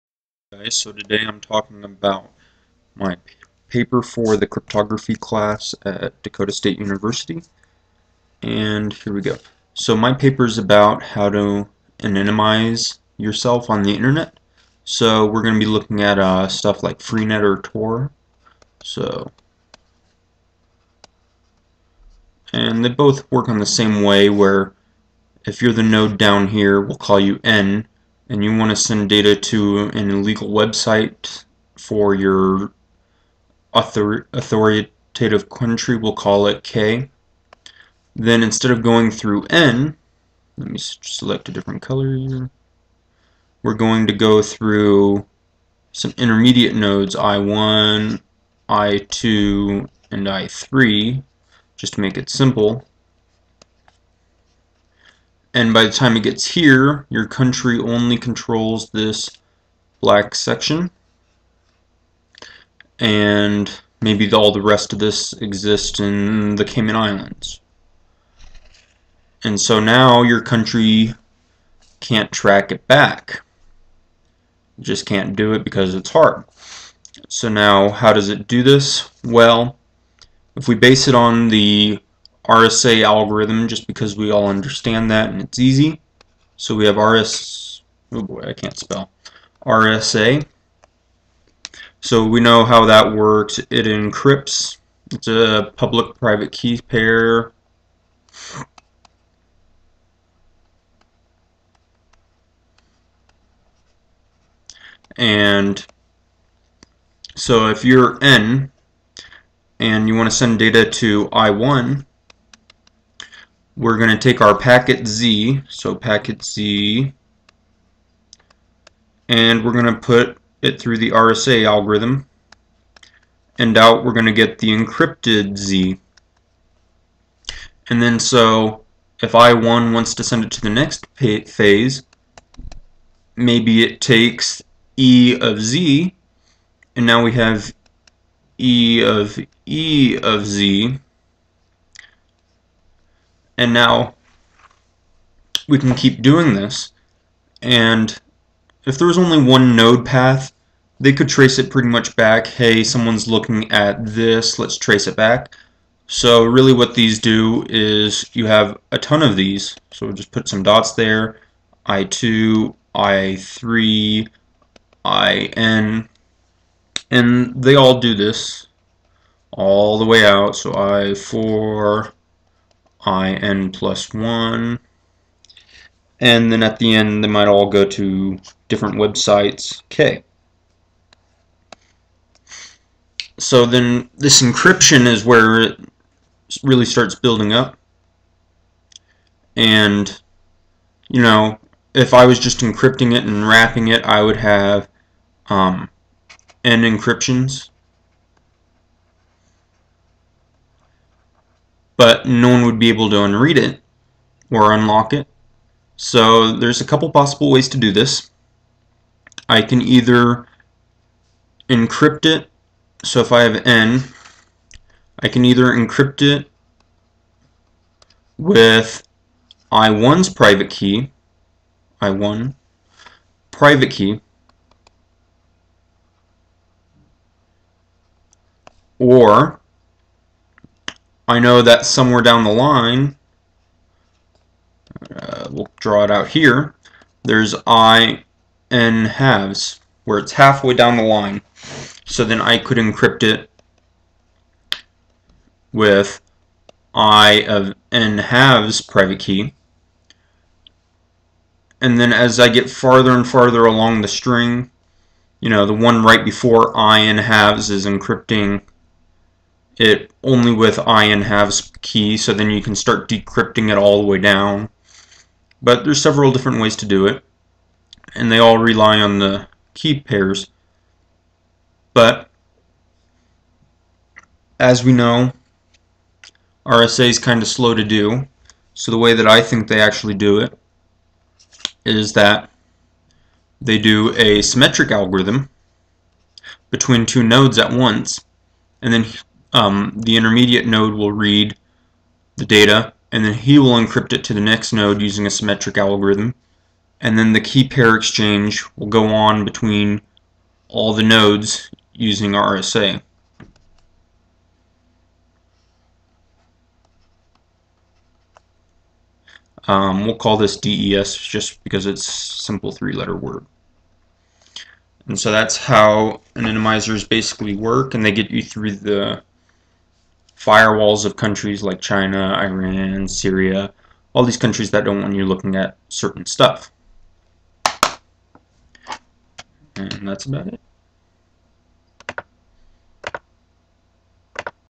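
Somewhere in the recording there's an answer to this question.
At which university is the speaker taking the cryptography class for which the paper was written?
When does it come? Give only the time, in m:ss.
0:06.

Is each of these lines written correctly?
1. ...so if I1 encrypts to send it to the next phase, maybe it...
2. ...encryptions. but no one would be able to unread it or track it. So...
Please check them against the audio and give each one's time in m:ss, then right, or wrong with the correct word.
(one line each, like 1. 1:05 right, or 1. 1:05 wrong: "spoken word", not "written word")
1. 2:08 wrong: "wants", not "encrypts"
2. 3:16 wrong: "unlock", not "track".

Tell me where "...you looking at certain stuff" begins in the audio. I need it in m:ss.
5:25.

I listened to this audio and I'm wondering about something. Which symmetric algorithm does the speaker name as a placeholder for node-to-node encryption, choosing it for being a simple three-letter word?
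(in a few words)
DES.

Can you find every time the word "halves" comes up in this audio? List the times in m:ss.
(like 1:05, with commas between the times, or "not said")
3:59, 4:08, 4:17, 4:21.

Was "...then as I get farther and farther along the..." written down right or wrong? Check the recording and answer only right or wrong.
right.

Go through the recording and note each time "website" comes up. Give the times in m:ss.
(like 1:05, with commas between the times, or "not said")
0:30, 2:58.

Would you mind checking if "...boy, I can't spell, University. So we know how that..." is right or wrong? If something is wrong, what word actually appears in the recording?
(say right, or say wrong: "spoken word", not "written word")
wrong: "RSA", not "University".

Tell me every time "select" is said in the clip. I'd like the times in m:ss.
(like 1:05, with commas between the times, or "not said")
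0:40.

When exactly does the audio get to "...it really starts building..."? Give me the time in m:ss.
3:05.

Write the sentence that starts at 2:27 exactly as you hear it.
And if there was only one node path, they could trace it pretty much back.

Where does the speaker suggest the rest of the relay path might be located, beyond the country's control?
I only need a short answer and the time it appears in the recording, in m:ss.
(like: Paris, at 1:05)
Cayman Islands, at 1:06.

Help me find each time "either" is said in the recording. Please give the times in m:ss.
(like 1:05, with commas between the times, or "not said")
3:29, 3:35.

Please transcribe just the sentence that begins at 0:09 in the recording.
So my paper is about how to anonymize yourself on the internet.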